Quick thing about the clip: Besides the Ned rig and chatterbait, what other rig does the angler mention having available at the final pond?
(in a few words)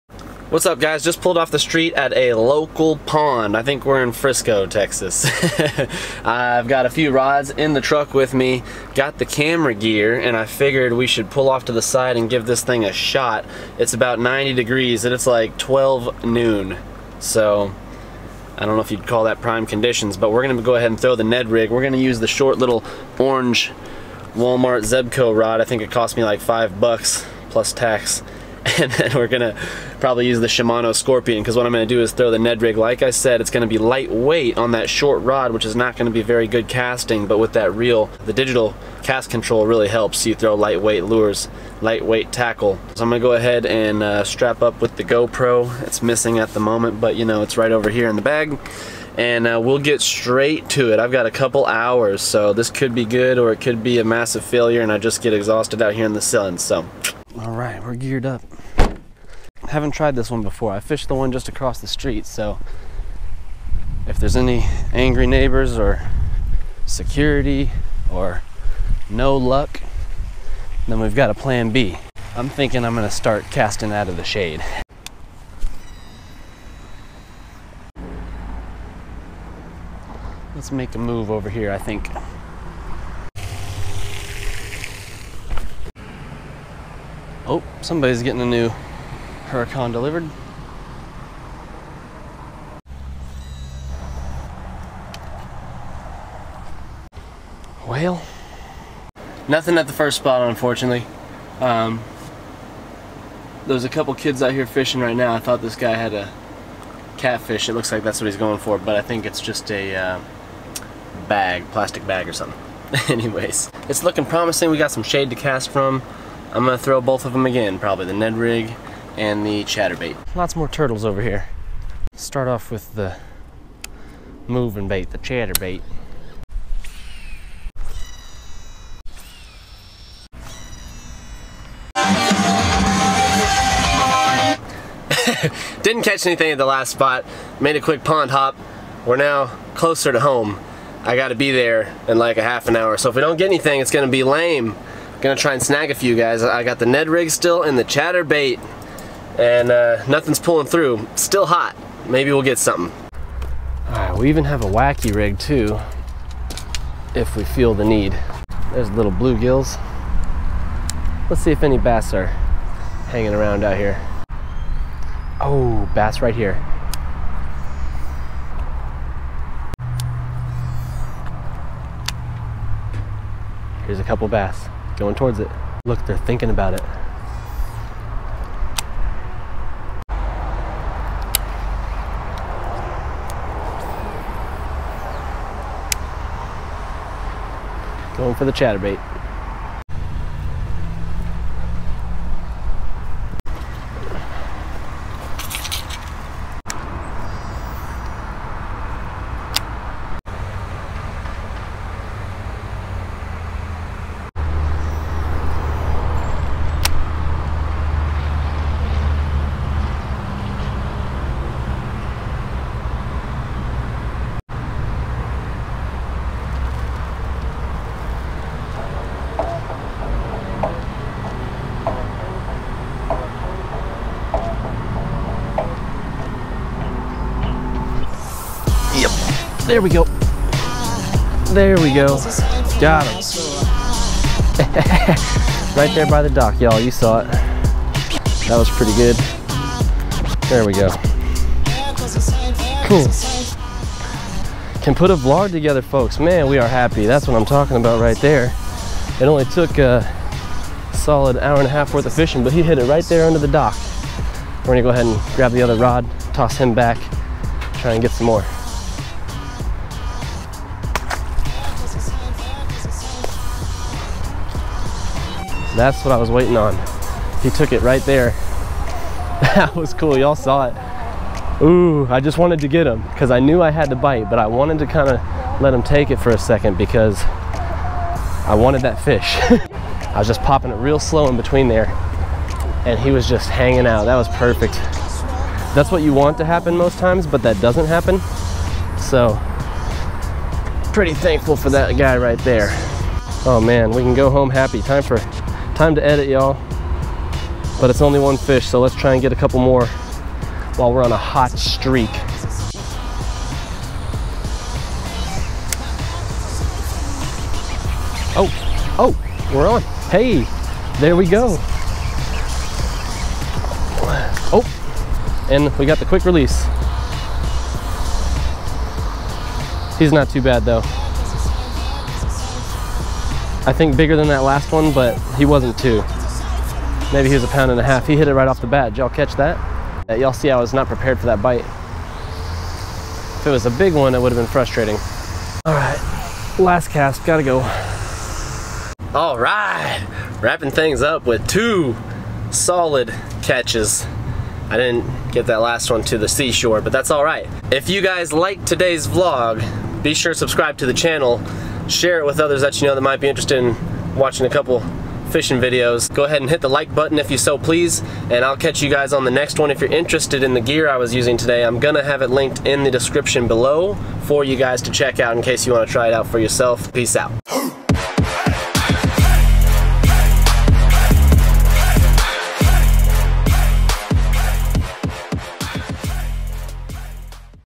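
Wacky rig.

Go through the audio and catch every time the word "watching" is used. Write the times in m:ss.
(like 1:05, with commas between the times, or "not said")
5:54.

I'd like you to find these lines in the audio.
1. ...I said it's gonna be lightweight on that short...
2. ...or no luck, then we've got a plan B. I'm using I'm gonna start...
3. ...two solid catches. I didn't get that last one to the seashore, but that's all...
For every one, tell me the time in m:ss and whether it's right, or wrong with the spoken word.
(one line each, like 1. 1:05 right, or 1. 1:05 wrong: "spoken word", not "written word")
1. 0:33 right
2. 1:08 wrong: "thinking", not "using"
3. 5:41 right.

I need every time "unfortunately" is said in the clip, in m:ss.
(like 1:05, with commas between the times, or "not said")
1:40.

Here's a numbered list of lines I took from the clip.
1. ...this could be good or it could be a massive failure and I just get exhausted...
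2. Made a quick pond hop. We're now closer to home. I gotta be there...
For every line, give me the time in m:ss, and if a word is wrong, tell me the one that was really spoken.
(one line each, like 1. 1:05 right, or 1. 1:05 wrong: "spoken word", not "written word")
1. 0:52 right
2. 2:17 right.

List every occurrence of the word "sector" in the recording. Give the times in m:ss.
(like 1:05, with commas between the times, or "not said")
not said.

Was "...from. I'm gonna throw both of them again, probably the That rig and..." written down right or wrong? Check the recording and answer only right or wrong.
wrong.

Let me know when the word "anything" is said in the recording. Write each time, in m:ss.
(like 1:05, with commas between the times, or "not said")
2:16, 2:23.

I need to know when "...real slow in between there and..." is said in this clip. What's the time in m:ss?
4:40.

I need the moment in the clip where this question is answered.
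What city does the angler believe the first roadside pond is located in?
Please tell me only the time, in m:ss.
0:04.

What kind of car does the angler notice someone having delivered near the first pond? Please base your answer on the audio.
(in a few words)
Huracan.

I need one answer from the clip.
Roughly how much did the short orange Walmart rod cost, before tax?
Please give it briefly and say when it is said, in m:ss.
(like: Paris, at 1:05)
$5, at 0:26.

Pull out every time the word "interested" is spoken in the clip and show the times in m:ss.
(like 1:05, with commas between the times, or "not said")
5:53, 5:59.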